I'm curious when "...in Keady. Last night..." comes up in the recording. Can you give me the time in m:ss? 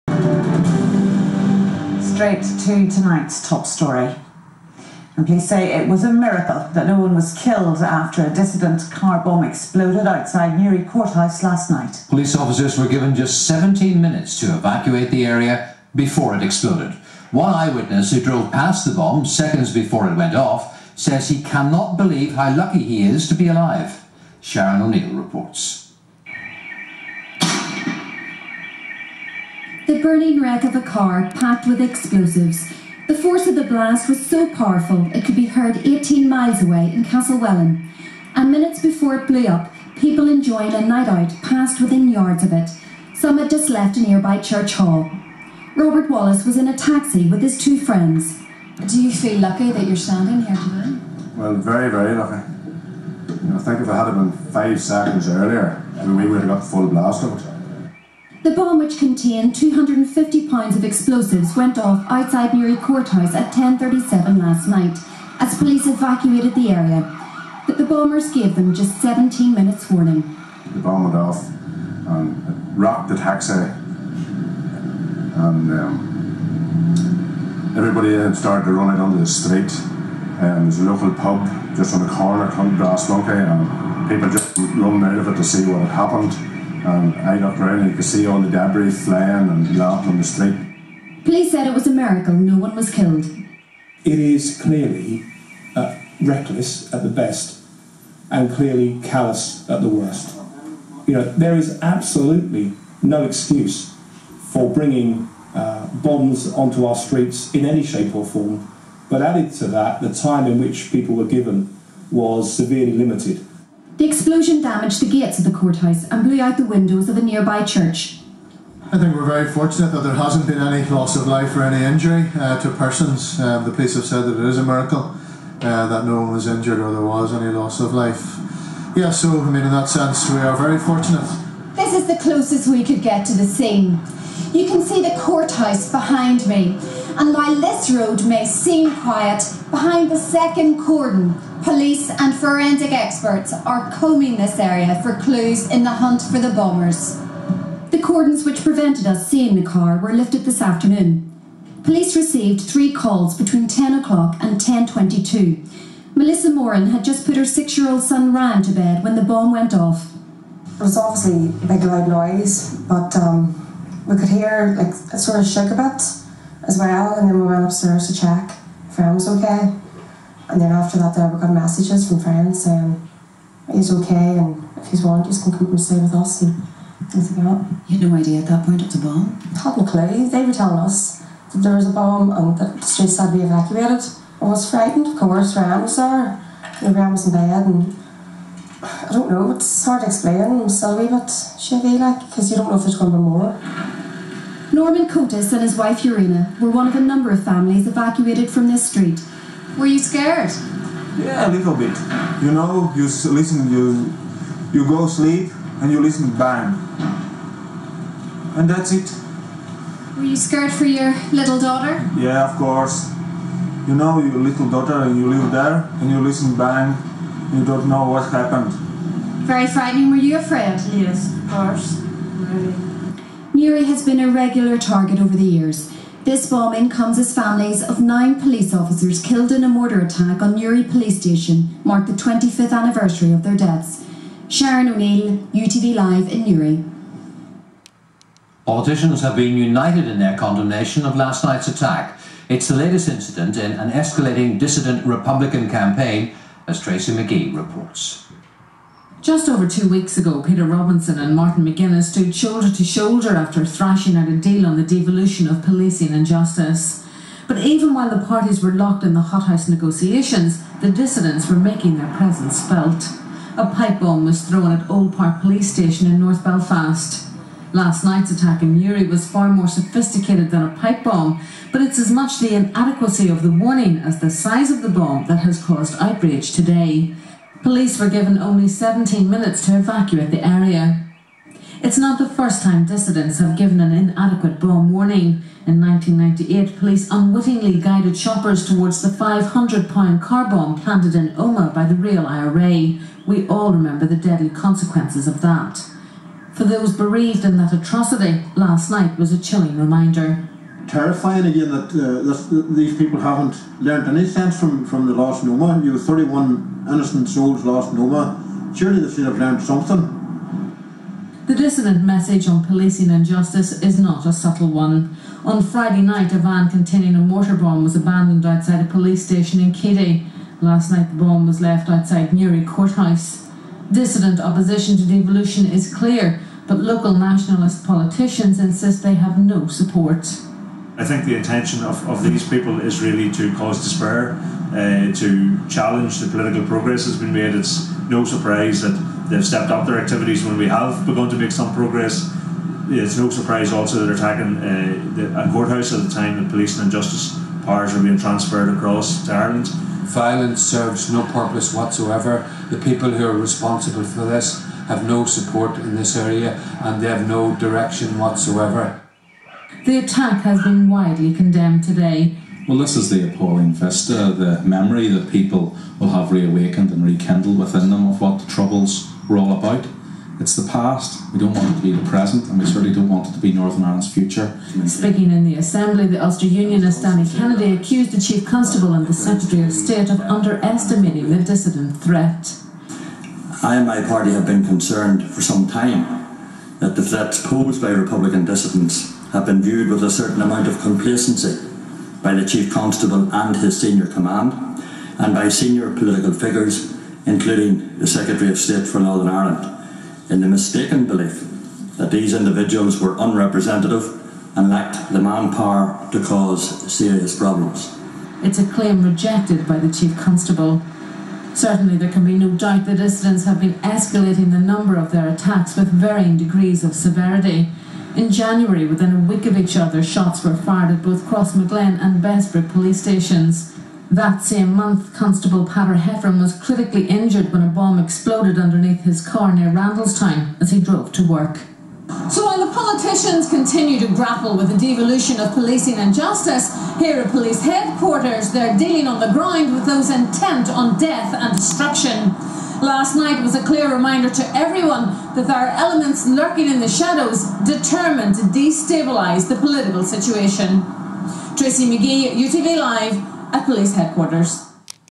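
5:19.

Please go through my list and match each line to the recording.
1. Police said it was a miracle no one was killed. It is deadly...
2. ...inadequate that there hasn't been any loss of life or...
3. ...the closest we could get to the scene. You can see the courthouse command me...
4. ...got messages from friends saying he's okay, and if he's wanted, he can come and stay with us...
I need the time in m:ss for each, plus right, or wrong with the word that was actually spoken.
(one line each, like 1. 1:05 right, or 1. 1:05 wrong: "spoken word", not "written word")
1. 1:31 wrong: "clearly", not "deadly"
2. 1:59 wrong: "fortunate", not "inadequate"
3. 2:12 wrong: "behind", not "command"
4. 2:51 right.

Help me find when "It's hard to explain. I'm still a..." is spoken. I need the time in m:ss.
3:09.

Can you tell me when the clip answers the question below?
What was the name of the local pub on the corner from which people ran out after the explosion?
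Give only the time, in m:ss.
1:22.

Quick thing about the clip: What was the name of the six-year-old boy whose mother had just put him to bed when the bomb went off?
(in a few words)
Ryan.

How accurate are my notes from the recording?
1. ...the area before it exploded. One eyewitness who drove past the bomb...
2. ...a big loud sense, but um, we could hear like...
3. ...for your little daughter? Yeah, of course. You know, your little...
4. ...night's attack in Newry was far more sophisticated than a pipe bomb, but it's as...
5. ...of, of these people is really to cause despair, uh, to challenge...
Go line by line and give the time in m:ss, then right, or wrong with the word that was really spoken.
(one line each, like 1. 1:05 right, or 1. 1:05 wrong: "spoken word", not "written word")
1. 0:15 right
2. 2:41 wrong: "noise", not "sense"
3. 3:30 right
4. 4:28 right
5. 5:31 right.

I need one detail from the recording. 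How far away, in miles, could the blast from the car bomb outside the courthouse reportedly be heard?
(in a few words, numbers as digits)
18 miles.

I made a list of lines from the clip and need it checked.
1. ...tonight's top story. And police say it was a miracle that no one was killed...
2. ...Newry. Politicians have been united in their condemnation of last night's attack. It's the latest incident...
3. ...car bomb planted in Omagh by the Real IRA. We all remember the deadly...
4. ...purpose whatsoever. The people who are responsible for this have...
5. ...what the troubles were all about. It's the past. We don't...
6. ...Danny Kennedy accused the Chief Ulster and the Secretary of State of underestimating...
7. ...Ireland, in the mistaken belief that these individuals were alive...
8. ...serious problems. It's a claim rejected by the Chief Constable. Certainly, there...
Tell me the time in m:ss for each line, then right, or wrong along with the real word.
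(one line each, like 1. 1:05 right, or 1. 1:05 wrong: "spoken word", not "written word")
1. 0:02 right
2. 3:56 right
3. 4:50 right
4. 5:51 right
5. 6:08 right
6. 6:17 wrong: "Constable", not "Ulster"
7. 6:39 wrong: "unrepresentative", not "alive"
8. 6:46 right.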